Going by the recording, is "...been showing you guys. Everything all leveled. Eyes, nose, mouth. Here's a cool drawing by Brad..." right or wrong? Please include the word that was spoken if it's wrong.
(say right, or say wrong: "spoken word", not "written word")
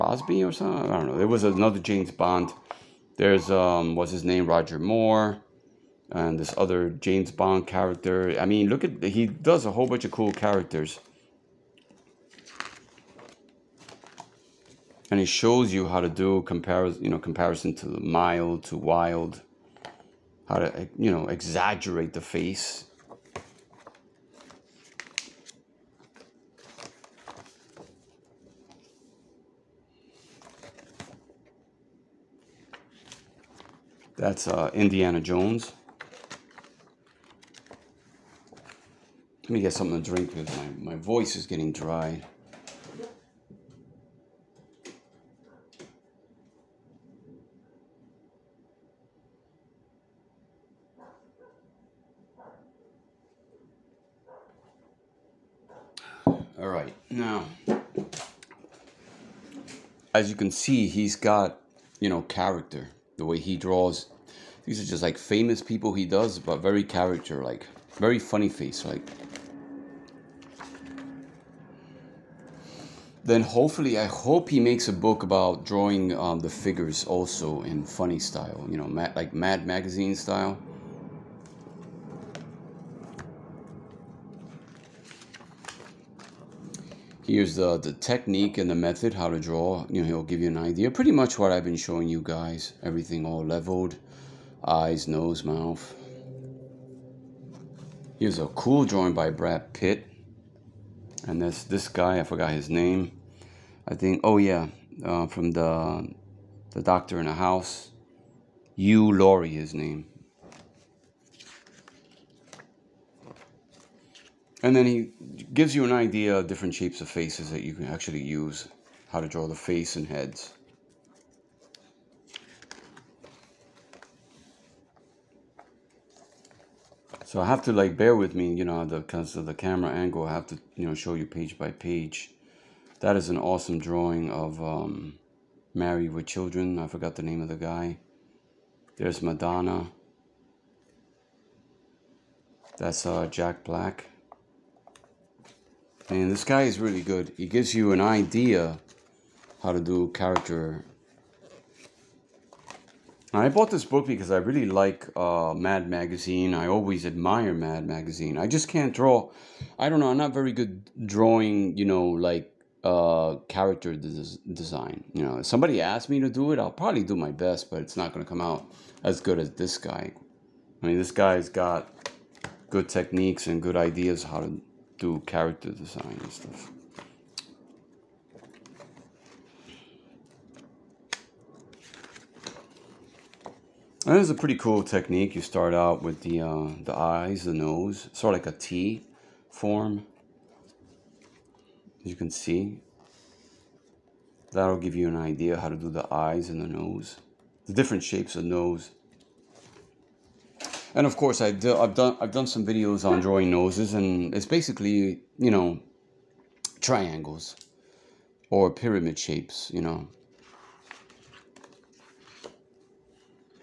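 right.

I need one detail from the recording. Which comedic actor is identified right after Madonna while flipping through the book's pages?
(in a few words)
Jack Black.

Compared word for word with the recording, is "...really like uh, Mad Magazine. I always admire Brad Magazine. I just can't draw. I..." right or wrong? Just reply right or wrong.
wrong.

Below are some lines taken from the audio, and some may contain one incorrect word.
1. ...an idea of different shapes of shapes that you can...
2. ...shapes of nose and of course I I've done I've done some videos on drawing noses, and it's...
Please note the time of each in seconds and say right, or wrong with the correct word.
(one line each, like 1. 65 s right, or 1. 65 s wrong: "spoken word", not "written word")
1. 115 s wrong: "faces", not "shapes"
2. 198 s right.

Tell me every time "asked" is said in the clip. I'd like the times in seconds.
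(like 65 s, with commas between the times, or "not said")
165 s.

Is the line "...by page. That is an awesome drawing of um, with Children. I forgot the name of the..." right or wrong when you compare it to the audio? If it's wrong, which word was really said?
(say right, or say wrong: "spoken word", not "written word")
right.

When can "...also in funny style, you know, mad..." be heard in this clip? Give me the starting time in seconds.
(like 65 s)
77 s.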